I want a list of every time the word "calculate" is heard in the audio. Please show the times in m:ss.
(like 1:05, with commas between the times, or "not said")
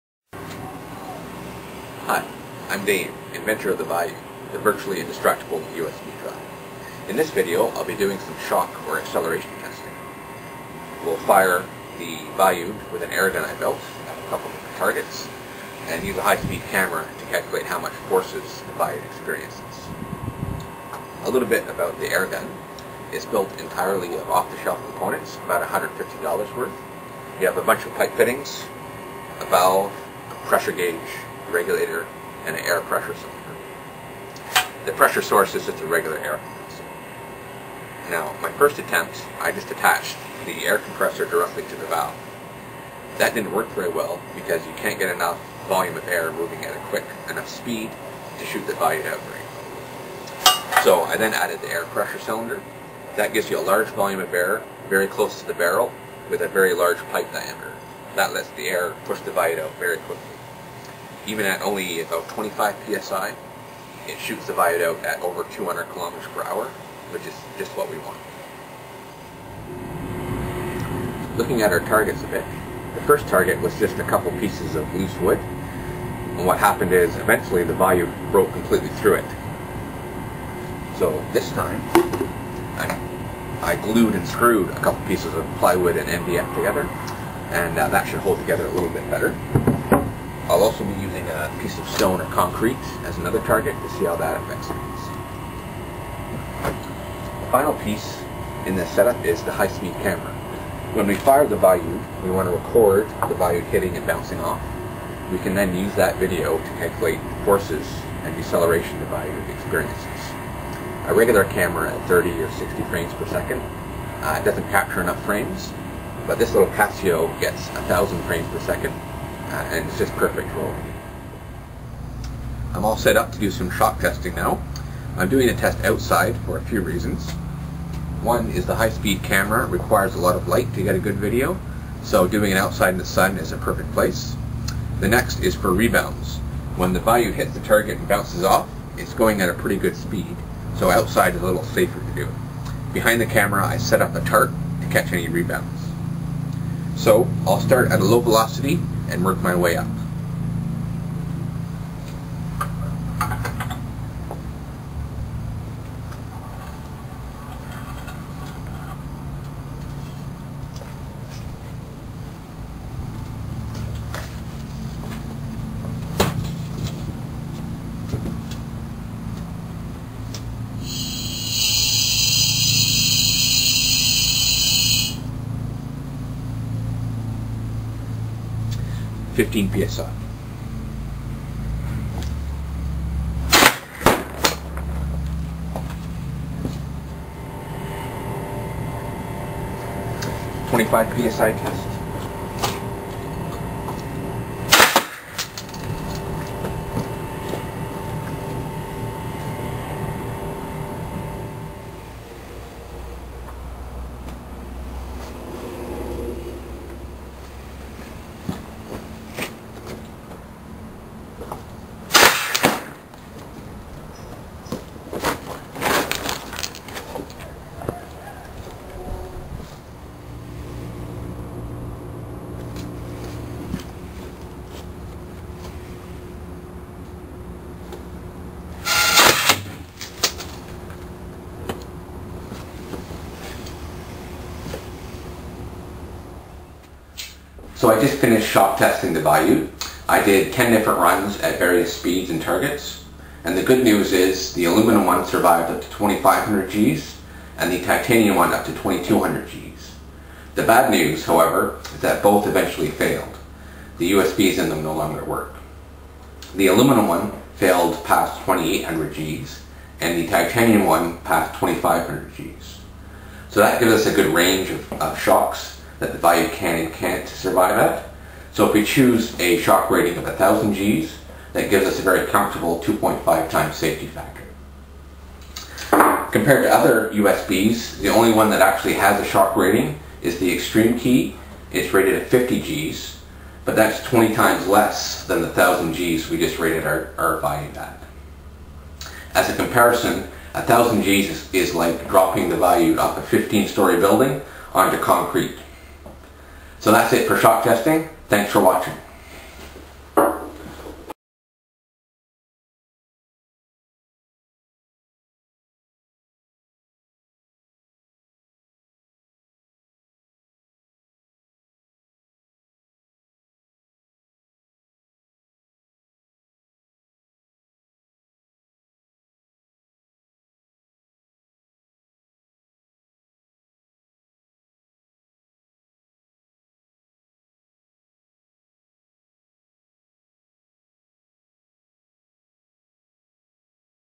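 0:17, 1:46.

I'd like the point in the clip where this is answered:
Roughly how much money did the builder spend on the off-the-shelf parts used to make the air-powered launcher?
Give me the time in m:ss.
0:25.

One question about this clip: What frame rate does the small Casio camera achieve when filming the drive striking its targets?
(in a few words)
1,000 frames per second.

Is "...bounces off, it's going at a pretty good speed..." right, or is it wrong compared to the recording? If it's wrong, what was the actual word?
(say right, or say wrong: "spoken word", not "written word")
right.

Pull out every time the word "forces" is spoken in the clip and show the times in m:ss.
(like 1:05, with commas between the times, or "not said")
0:18, 1:47.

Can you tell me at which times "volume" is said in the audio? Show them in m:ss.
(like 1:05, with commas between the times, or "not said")
0:45, 0:53.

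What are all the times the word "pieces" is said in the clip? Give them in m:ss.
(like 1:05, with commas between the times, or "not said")
1:14, 1:25, 1:31, 1:37.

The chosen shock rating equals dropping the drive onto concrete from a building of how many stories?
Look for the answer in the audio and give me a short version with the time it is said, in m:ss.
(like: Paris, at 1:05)
15, at 4:53.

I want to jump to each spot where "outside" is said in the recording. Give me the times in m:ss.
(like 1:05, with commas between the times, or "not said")
2:05, 2:12, 2:20.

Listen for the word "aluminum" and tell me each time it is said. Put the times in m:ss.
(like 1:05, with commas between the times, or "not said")
4:04, 4:16.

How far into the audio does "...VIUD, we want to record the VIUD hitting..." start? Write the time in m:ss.
1:41.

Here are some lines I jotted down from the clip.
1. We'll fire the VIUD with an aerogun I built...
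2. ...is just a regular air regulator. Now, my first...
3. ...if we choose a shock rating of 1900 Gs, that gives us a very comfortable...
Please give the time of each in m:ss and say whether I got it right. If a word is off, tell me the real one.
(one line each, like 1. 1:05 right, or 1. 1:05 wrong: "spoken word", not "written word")
1. 0:11 right
2. 0:35 wrong: "compressor", not "regulator"
3. 4:28 wrong: "1000", not "1900".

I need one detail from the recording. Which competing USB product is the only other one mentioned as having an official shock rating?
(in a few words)
XtremKey.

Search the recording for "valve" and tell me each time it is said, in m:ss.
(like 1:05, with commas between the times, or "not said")
0:29, 0:41.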